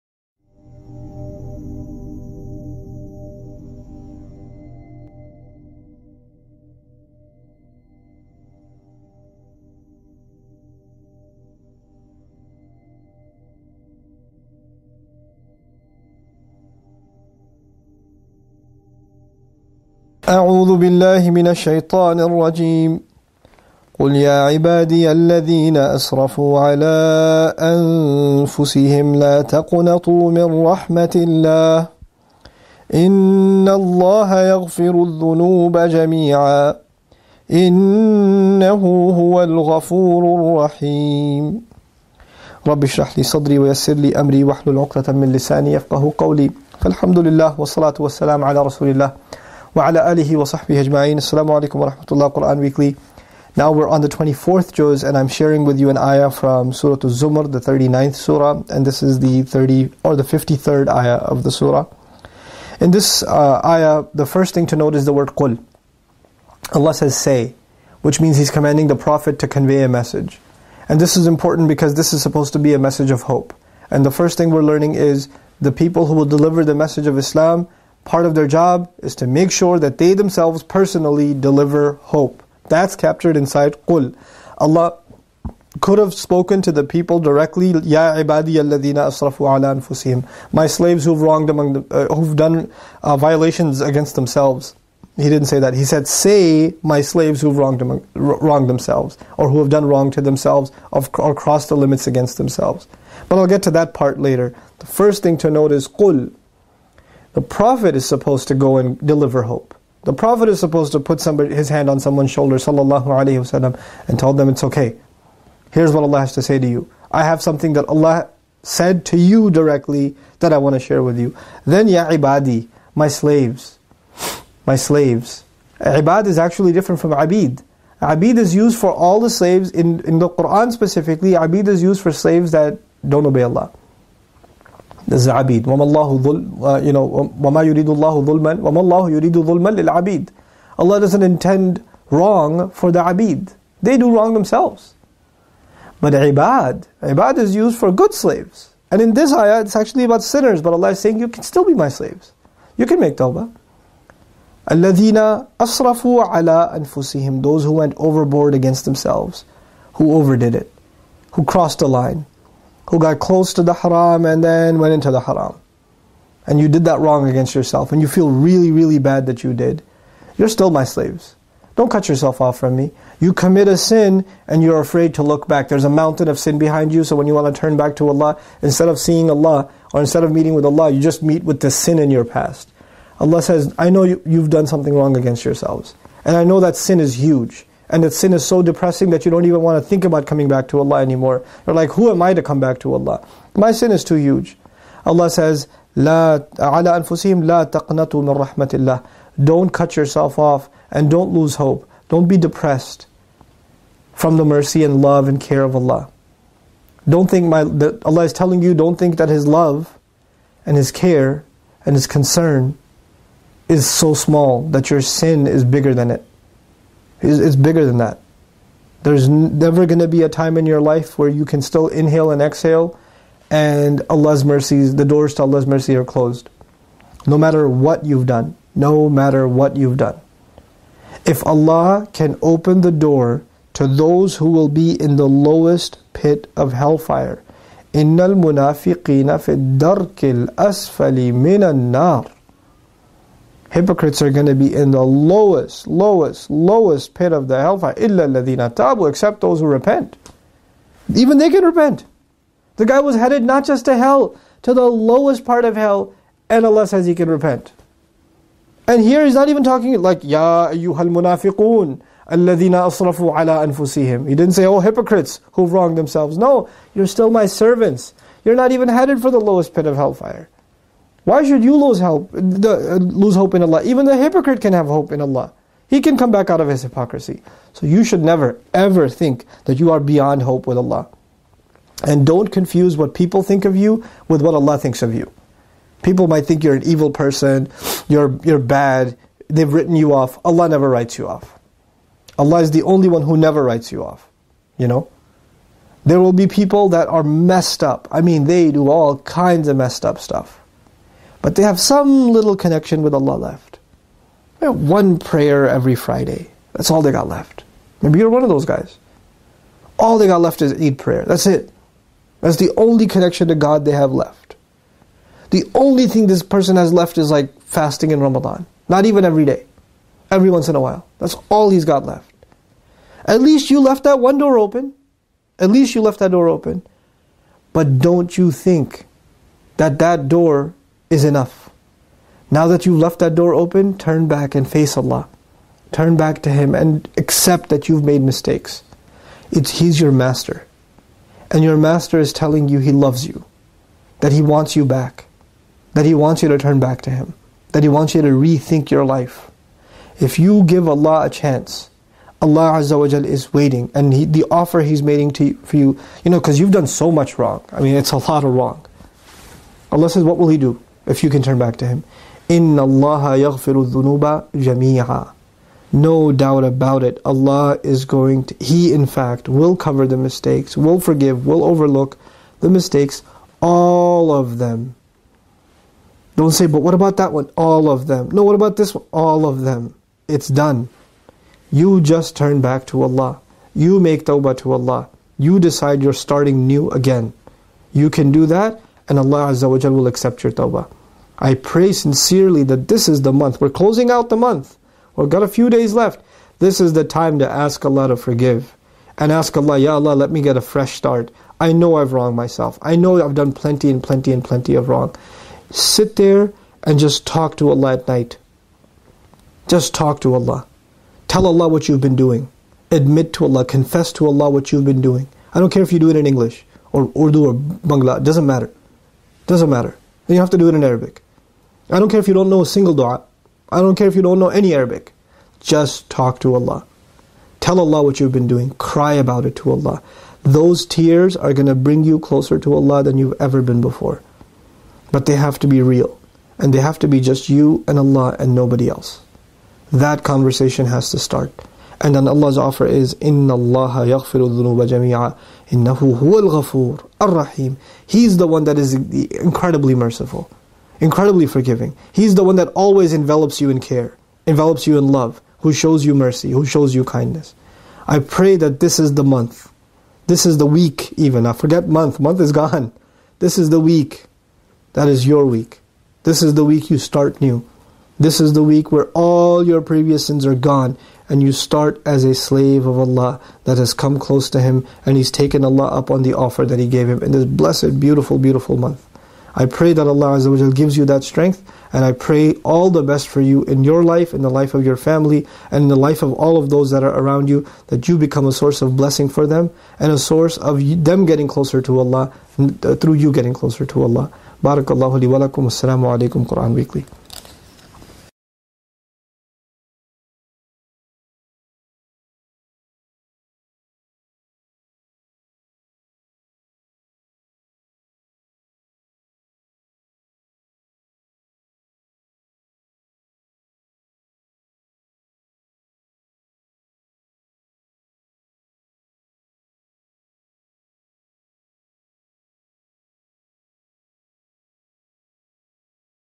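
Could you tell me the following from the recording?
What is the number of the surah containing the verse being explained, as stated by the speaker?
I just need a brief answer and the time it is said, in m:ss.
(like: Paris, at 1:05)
39th, at 0:57.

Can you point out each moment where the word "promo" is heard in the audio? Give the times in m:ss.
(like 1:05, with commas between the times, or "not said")
not said.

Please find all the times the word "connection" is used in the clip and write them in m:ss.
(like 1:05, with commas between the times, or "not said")
5:02, 5:13.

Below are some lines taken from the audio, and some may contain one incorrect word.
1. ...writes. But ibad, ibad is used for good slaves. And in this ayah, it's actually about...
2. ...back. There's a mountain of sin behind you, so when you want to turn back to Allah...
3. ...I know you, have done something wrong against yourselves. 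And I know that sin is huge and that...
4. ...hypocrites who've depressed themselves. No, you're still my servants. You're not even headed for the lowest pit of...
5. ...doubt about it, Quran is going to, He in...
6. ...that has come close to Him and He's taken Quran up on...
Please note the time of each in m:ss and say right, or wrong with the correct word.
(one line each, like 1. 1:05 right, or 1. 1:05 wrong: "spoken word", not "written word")
1. 2:24 wrong: "themselves", not "writes"
2. 2:55 right
3. 3:03 right
4. 4:24 wrong: "wronged", not "depressed"
5. 6:06 wrong: "Allah", not "Quran"
6. 7:53 wrong: "Allah", not "Quran".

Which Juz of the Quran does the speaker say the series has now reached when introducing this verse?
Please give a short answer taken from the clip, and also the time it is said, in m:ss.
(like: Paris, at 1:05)
24th, at 0:54.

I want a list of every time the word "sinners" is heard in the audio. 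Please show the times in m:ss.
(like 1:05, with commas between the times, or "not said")
2:30.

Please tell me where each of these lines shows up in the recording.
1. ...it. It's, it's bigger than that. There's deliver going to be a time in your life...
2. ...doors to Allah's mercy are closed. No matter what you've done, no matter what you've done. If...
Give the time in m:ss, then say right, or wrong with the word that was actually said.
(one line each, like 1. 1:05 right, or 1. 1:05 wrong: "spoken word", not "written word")
1. 3:36 wrong: "never", not "deliver"
2. 3:45 right.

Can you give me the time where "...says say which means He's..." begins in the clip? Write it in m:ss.
1:06.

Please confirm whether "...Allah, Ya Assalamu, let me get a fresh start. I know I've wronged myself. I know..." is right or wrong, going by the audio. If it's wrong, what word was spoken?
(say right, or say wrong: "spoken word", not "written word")
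wrong: "Allah", not "Assalamu".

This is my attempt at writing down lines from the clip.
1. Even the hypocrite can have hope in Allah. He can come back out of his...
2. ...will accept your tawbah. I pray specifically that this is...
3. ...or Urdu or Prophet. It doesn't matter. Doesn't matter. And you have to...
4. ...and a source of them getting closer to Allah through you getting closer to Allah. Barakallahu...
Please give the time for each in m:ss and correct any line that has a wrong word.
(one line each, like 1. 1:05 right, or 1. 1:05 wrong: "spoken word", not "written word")
1. 4:33 right
2. 6:29 wrong: "sincerely", not "specifically"
3. 6:56 wrong: "Bangla", not "Prophet"
4. 8:09 right.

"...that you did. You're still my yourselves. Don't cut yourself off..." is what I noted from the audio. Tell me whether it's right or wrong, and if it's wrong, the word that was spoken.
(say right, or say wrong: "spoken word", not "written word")
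wrong: "slaves", not "yourselves".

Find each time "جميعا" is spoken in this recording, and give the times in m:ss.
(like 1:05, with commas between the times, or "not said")
0:35, 7:24.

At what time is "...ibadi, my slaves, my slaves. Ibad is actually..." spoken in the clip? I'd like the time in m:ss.
2:02.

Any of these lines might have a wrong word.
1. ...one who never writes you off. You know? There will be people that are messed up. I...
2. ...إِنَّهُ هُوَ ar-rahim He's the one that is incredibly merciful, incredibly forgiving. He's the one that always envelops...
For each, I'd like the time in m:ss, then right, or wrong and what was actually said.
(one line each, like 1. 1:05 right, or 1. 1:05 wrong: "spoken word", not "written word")
1. 4:53 right
2. 7:25 right.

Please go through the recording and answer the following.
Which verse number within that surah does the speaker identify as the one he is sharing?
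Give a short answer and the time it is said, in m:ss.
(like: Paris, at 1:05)
53rd, at 1:00.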